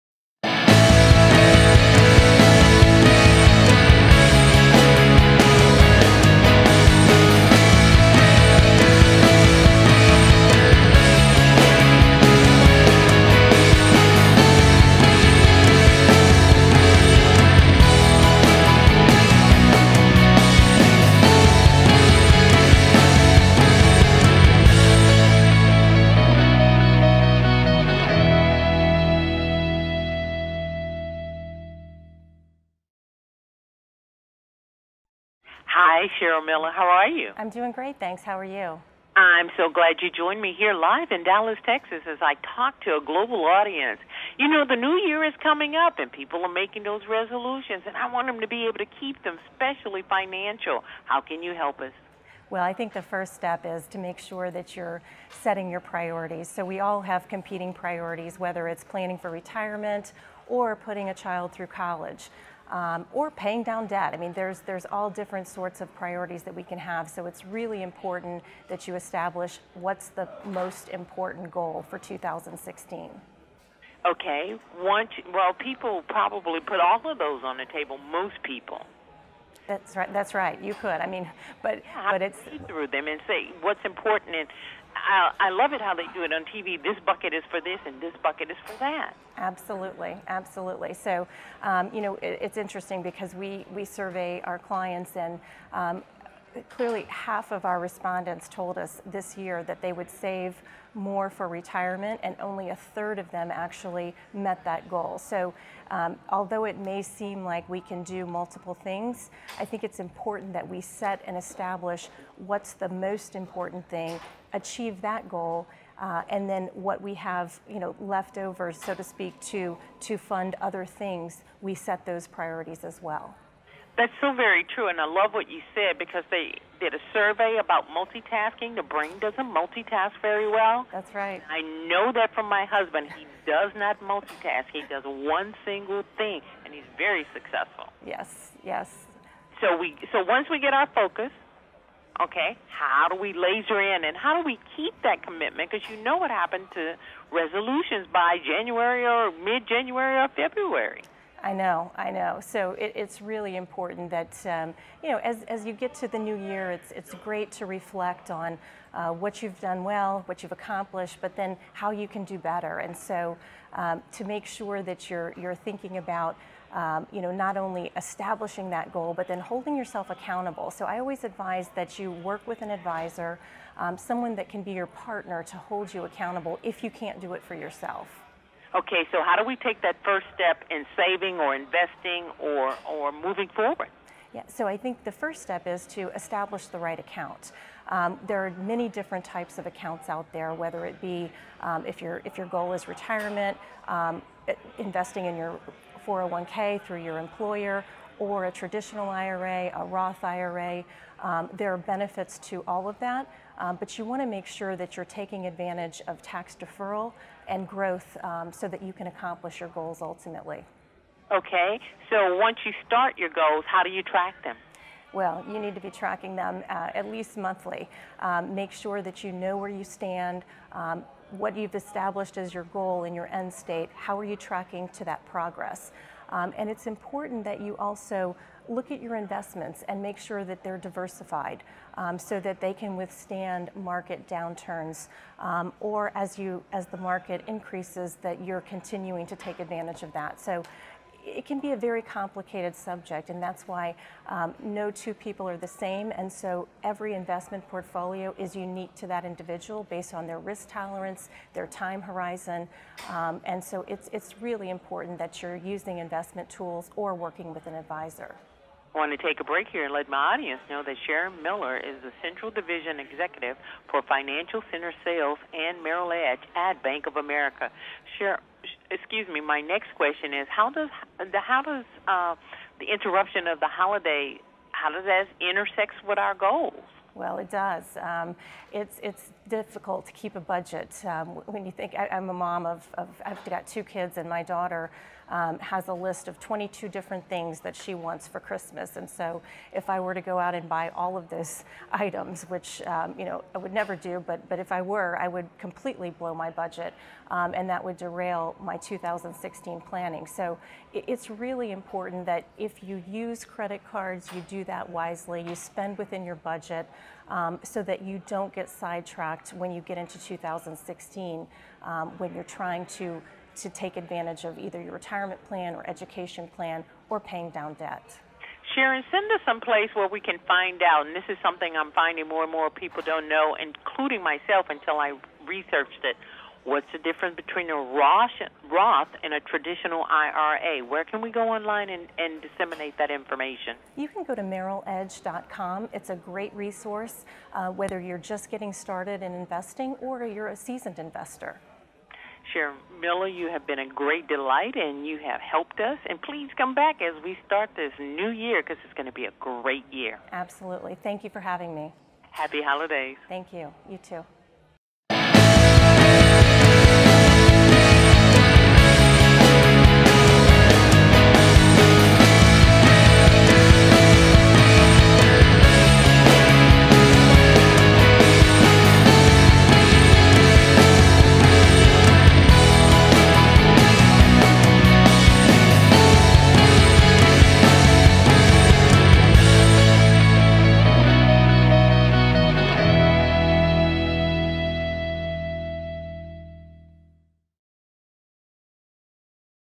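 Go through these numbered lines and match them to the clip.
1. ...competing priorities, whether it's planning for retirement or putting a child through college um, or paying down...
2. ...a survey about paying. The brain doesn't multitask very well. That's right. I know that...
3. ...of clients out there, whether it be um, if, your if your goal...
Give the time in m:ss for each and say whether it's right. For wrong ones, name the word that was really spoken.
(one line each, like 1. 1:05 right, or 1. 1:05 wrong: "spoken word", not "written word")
1. 0:57 right
2. 2:06 wrong: "multitasking", not "paying"
3. 3:09 wrong: "accounts", not "clients".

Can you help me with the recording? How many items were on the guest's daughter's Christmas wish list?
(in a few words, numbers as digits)
22.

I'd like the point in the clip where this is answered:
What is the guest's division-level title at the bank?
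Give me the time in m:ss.
4:22.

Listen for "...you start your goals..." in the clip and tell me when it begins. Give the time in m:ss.
3:32.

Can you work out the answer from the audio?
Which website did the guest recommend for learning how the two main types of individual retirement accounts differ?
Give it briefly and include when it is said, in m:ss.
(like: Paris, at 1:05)
MerrillEdge.com, at 5:34.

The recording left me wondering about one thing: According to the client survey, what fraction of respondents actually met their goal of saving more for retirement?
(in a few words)
a third.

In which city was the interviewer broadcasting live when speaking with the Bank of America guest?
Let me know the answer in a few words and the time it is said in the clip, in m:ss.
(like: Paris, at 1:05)
Dallas, Texas, at 0:41.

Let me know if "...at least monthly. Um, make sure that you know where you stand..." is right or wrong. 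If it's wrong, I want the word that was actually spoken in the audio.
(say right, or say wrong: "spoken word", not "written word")
right.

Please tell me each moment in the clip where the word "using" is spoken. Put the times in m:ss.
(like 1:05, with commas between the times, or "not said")
4:15.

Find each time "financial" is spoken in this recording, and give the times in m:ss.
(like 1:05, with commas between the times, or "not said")
0:50, 4:24.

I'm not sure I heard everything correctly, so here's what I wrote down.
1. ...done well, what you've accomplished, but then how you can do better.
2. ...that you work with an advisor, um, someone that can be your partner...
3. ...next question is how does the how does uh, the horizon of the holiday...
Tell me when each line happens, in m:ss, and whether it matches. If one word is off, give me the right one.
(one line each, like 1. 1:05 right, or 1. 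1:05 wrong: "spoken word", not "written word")
1. 2:39 right
2. 2:51 right
3. 4:29 wrong: "interruption", not "horizon".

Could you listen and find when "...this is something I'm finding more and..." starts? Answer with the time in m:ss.
5:21.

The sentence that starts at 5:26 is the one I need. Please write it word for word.
What's the difference between a Roth and a traditional IRA?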